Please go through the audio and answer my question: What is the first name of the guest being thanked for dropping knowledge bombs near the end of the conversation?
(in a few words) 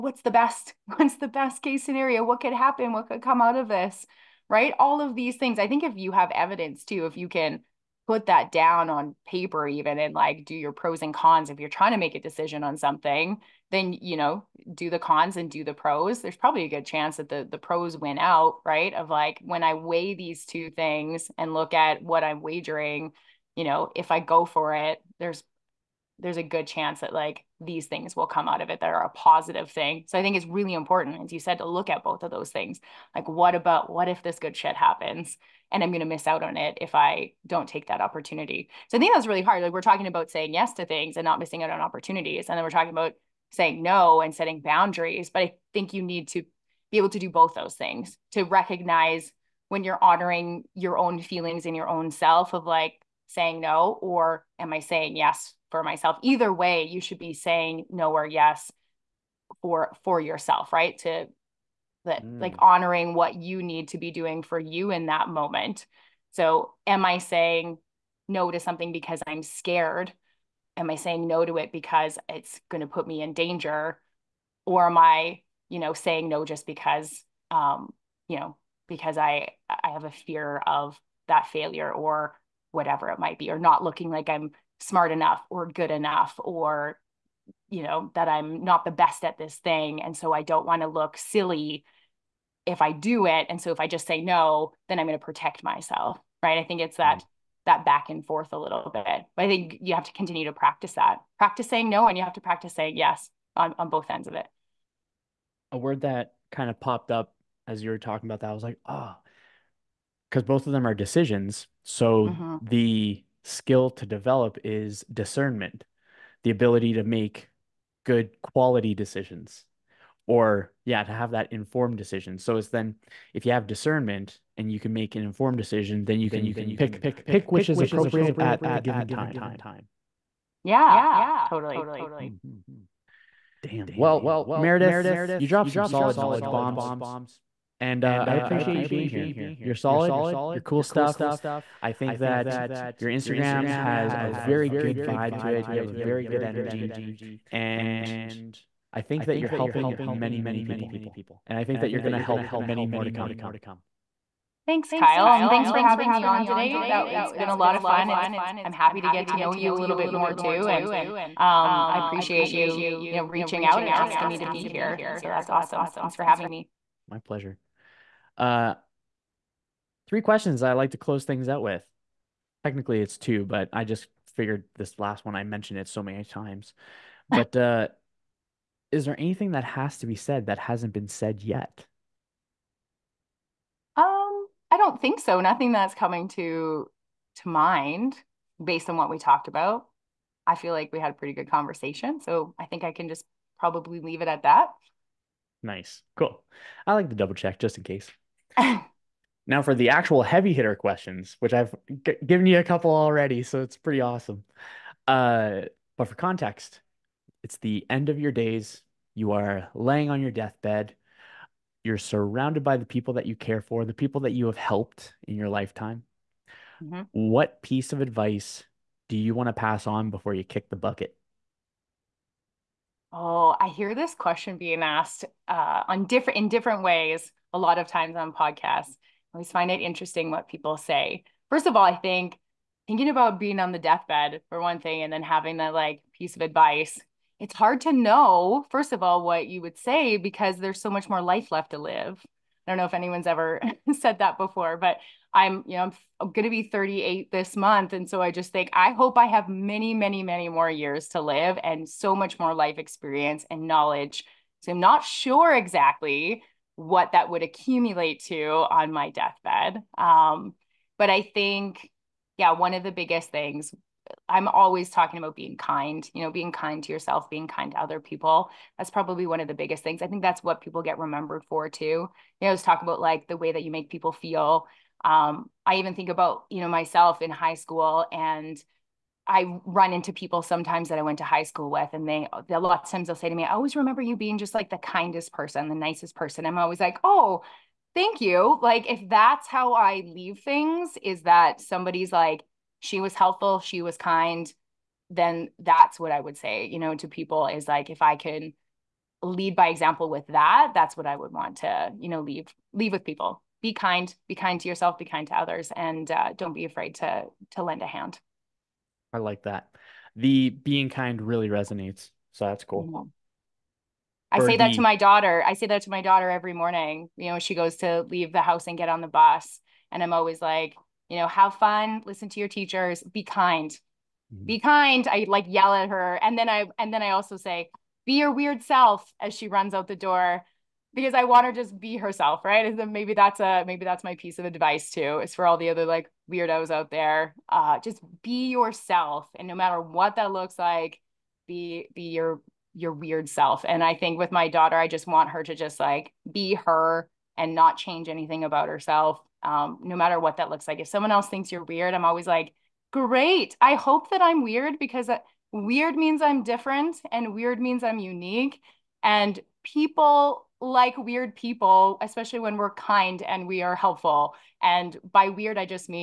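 Meredith.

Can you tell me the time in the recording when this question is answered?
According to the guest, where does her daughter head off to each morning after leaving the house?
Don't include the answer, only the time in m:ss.
5:19.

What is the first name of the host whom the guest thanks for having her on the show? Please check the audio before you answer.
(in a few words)
Kyle.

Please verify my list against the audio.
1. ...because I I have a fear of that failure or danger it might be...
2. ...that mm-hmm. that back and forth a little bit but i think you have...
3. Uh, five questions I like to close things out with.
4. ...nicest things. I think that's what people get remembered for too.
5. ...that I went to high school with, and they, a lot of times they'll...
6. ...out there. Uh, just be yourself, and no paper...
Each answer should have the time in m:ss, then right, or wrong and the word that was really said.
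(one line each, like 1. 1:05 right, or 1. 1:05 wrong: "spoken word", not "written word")
1. 1:18 wrong: "whatever", not "danger"
2. 1:36 right
3. 2:48 wrong: "three", not "five"
4. 4:29 wrong: "biggest", not "nicest"
5. 4:40 right
6. 5:36 wrong: "matter", not "paper".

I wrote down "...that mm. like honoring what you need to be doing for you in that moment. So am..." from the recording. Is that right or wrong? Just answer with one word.
right.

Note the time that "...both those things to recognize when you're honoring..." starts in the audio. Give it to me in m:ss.
0:47.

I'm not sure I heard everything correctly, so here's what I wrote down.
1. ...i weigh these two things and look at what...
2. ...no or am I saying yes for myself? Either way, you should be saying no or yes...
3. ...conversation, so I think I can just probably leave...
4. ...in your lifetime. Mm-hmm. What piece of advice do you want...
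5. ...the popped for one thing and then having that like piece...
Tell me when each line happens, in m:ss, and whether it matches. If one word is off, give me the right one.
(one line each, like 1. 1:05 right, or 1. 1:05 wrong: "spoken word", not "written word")
1. 0:19 right
2. 0:53 right
3. 3:11 right
4. 3:35 right
5. 3:53 wrong: "deathbed", not "popped".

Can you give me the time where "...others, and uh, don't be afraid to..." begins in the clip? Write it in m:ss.
5:05.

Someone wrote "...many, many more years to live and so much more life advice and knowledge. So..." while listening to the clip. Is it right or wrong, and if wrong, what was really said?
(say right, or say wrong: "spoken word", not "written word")
wrong: "experience", not "advice".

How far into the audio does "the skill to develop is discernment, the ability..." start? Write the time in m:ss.
1:52.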